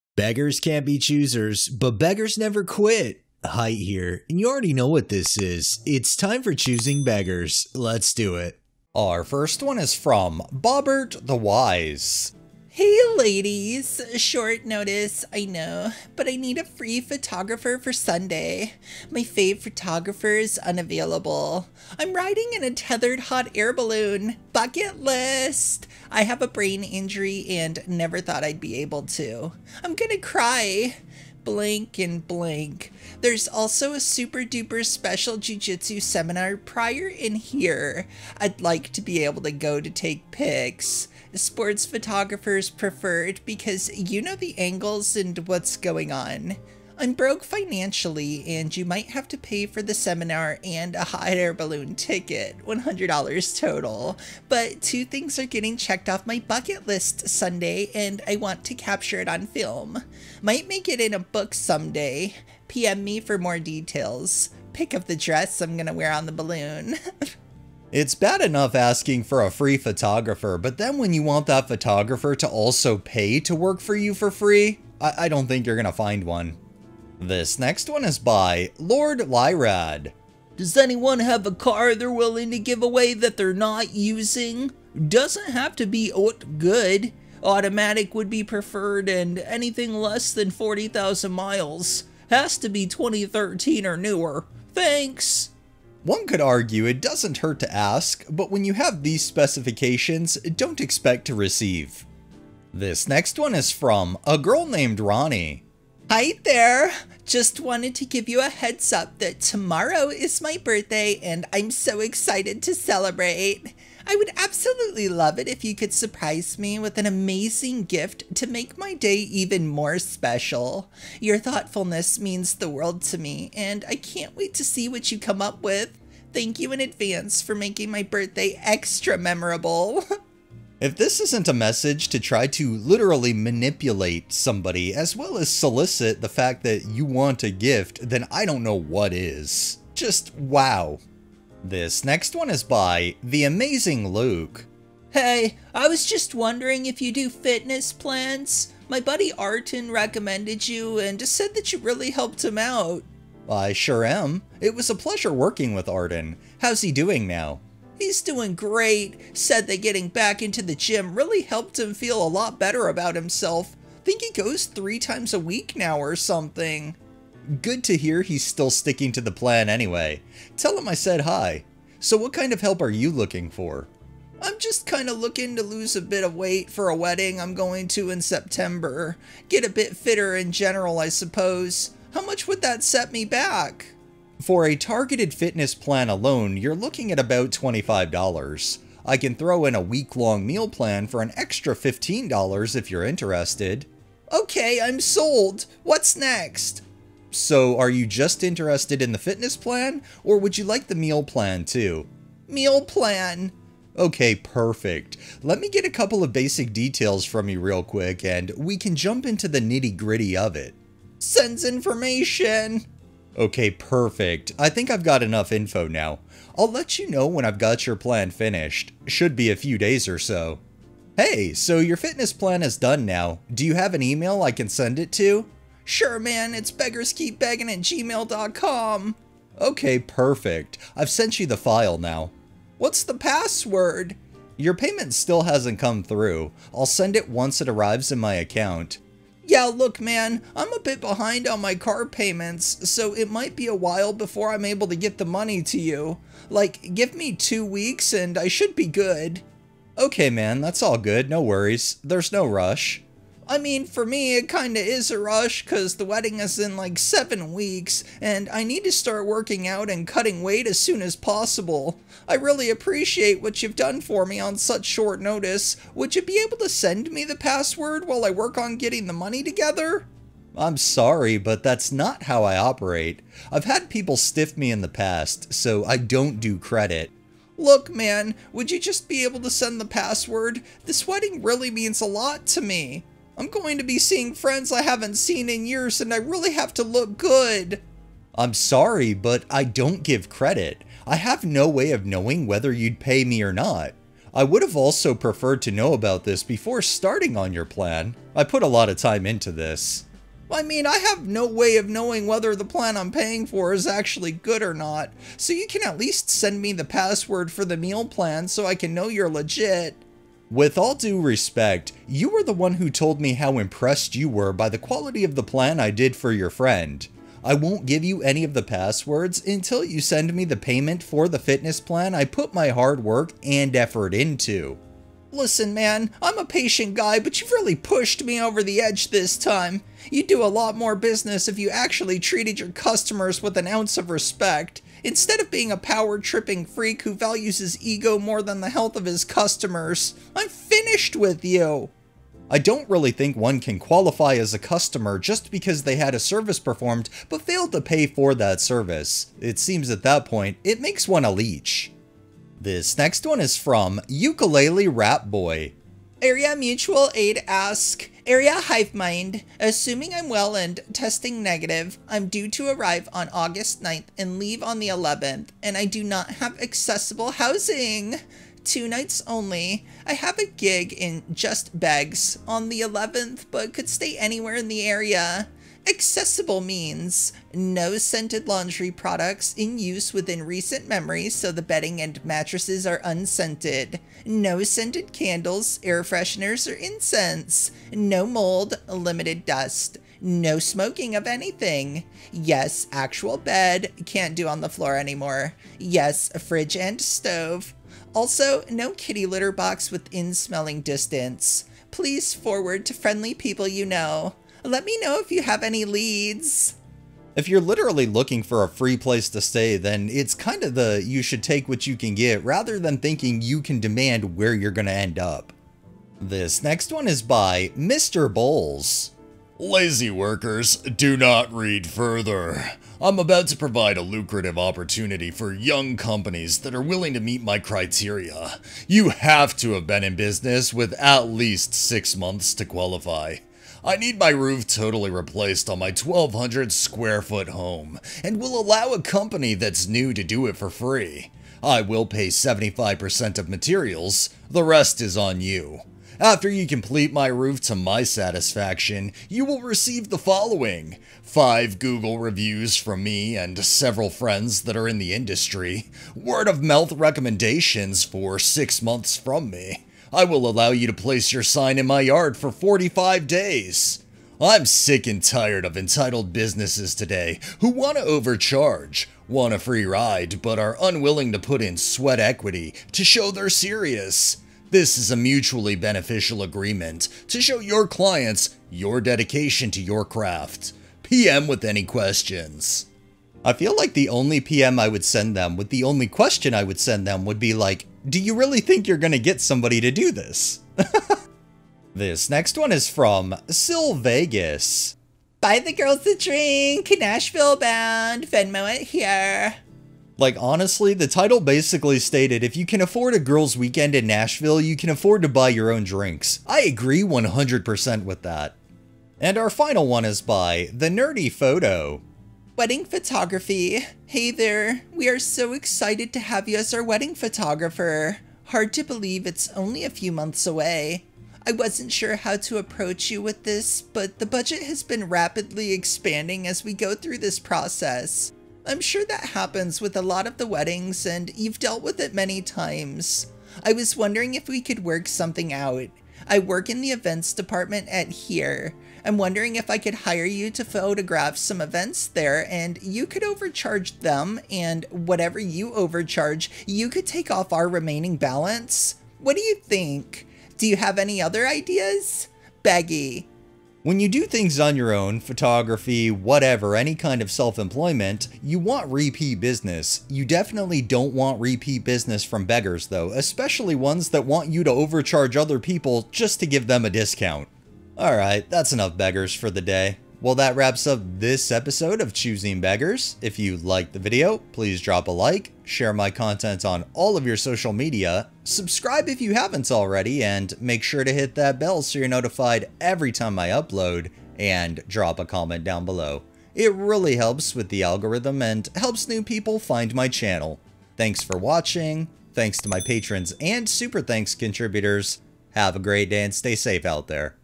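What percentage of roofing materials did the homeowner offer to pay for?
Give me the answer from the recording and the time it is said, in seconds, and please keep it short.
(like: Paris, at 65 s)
75%, at 442 s.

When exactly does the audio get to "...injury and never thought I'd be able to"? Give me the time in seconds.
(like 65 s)
26 s.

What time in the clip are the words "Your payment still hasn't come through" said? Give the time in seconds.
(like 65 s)
234 s.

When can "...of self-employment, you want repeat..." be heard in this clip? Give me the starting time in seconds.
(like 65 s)
557 s.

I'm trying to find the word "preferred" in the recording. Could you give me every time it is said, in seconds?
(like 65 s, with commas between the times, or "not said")
42 s, 88 s, 295 s.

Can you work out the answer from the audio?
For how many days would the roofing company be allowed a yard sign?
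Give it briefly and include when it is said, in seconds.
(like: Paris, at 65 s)
45, at 462 s.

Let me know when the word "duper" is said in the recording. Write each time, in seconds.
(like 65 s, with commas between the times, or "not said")
34 s.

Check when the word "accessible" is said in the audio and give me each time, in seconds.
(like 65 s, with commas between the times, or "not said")
366 s, 375 s.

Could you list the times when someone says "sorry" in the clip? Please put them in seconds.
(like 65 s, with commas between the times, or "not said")
270 s, 288 s.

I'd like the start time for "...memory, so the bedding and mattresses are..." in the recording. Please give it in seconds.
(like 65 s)
380 s.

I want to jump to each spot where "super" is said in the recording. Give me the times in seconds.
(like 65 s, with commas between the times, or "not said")
33 s, 593 s.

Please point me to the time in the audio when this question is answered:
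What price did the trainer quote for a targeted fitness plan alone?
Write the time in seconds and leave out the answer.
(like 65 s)
187 s.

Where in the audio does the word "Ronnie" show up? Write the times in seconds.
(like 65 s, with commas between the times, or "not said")
104 s.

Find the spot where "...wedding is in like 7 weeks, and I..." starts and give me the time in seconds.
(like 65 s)
256 s.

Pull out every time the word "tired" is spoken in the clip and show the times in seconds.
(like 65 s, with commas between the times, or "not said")
465 s.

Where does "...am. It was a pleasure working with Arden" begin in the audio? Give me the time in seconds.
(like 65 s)
154 s.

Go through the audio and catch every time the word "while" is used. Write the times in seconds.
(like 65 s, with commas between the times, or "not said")
243 s, 268 s.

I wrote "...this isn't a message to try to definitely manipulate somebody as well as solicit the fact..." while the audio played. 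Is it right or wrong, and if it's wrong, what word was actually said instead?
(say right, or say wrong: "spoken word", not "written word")
wrong: "literally", not "definitely".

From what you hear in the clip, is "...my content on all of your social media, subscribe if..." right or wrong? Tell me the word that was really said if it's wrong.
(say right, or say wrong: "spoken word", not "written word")
right.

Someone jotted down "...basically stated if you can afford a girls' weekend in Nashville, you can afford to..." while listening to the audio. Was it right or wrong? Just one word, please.
right.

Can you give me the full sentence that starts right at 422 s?
I'm about to provide a lucrative opportunity for young companies that are willing to meet my criteria.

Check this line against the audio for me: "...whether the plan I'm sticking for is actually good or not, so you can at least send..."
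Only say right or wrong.
wrong.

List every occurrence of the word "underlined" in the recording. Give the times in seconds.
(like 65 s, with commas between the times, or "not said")
not said.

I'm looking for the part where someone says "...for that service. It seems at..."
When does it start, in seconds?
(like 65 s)
348 s.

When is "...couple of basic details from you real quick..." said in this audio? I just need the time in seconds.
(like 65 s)
205 s.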